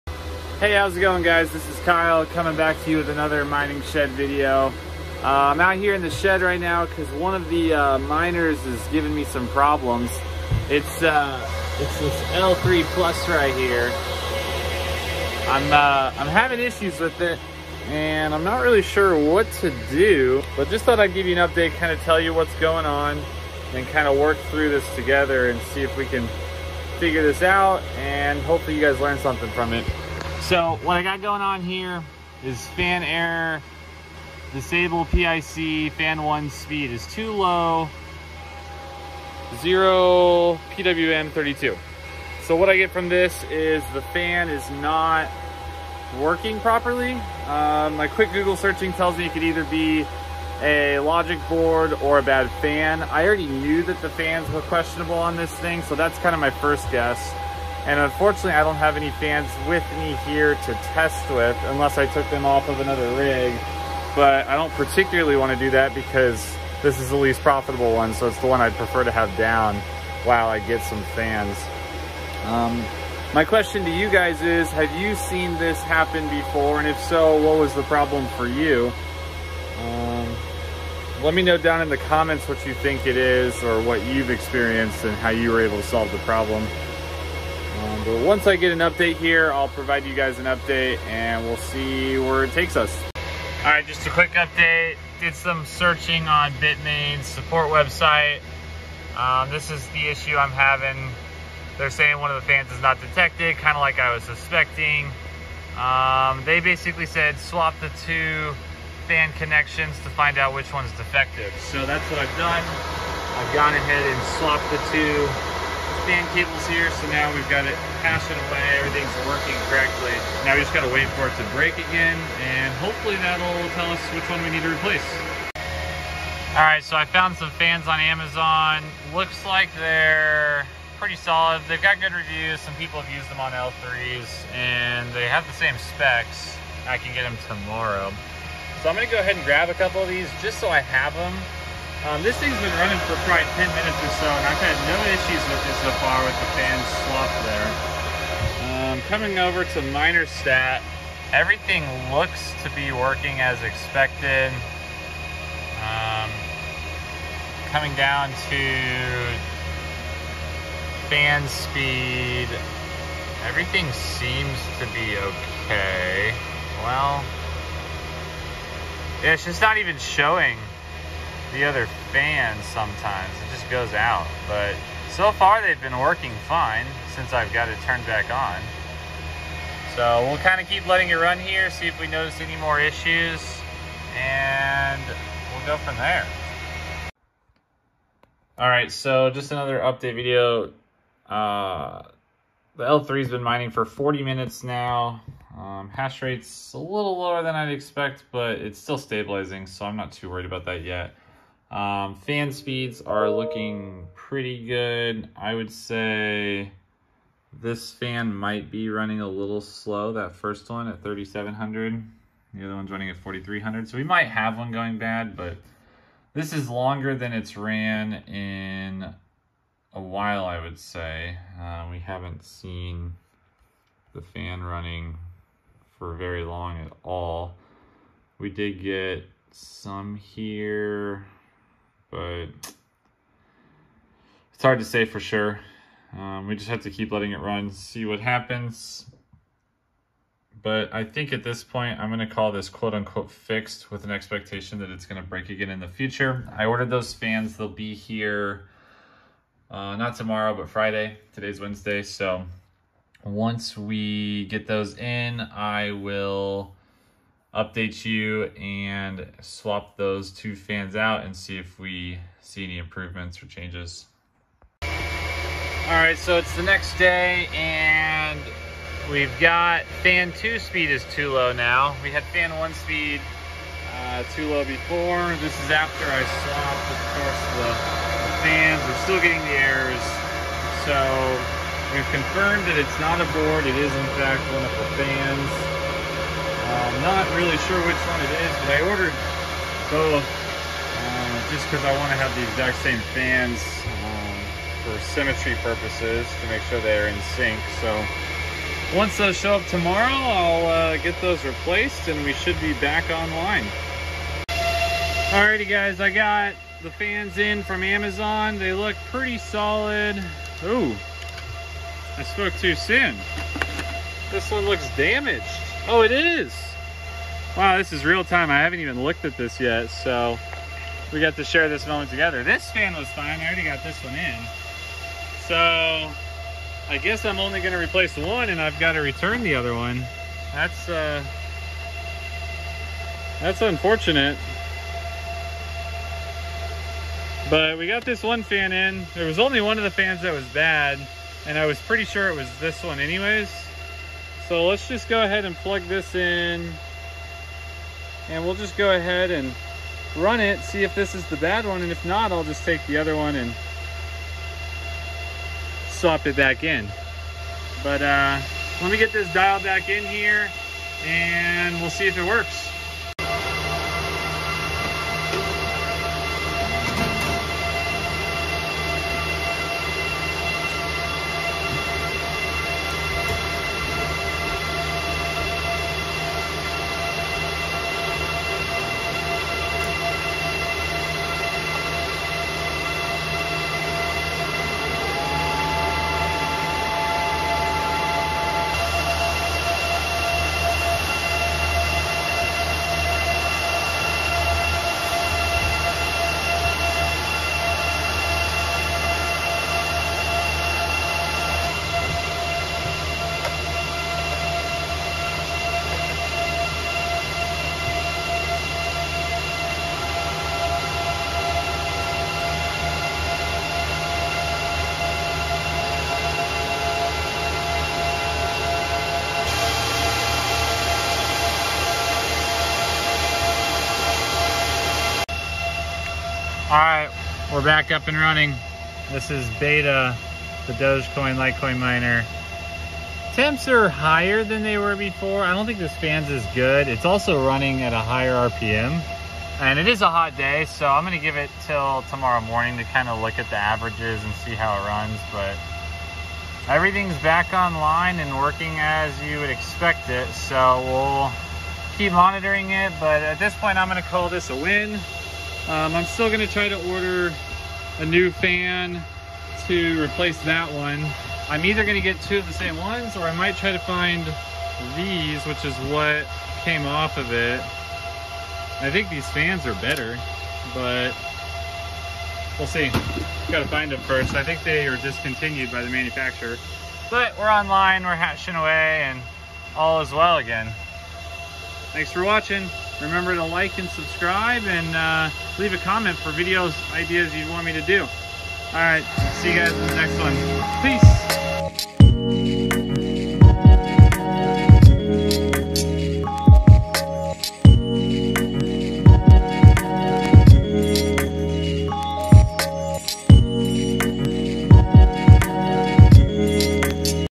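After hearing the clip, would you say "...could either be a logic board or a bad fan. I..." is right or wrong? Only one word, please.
right.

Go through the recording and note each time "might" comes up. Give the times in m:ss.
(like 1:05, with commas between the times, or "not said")
3:28, 3:34, 7:43.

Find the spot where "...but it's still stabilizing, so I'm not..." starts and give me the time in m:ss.
3:18.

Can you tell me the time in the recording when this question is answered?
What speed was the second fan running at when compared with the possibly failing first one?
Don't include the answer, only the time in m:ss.
3:33.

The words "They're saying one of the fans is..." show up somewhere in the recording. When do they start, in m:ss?
1:41.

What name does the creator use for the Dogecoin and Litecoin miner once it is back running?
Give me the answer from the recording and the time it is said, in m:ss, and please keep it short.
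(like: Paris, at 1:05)
beta, at 7:09.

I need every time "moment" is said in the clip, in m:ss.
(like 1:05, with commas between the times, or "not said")
5:21.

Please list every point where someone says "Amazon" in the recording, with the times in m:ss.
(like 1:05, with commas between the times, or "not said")
2:07, 5:07.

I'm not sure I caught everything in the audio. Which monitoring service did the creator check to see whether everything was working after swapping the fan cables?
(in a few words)
minerstat.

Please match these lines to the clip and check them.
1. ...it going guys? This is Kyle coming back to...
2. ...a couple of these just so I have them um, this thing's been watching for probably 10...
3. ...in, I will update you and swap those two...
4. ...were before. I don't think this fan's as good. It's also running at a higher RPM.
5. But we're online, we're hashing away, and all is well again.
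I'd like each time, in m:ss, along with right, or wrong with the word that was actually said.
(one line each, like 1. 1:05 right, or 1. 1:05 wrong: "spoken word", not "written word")
1. 0:00 right
2. 2:19 wrong: "running", not "watching"
3. 4:14 right
4. 7:14 right
5. 7:57 right.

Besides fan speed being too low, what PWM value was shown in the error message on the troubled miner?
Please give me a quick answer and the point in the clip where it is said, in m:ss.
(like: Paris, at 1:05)
32, at 0:40.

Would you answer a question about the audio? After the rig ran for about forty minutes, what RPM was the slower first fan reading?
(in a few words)
3,700.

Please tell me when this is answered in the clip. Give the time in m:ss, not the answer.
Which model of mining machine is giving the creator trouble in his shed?
0:12.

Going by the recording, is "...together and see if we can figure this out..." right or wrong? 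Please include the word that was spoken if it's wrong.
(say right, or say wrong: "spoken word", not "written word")
right.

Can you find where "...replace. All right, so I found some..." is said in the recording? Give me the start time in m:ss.
2:04.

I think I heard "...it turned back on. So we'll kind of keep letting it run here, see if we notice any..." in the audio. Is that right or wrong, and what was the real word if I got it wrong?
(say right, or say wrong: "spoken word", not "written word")
right.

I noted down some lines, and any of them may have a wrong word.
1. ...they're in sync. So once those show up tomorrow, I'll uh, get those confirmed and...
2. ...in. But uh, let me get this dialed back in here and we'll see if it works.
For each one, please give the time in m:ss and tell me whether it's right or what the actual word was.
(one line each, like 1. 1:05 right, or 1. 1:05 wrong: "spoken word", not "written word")
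1. 4:56 wrong: "replaced", not "confirmed"
2. 5:56 right.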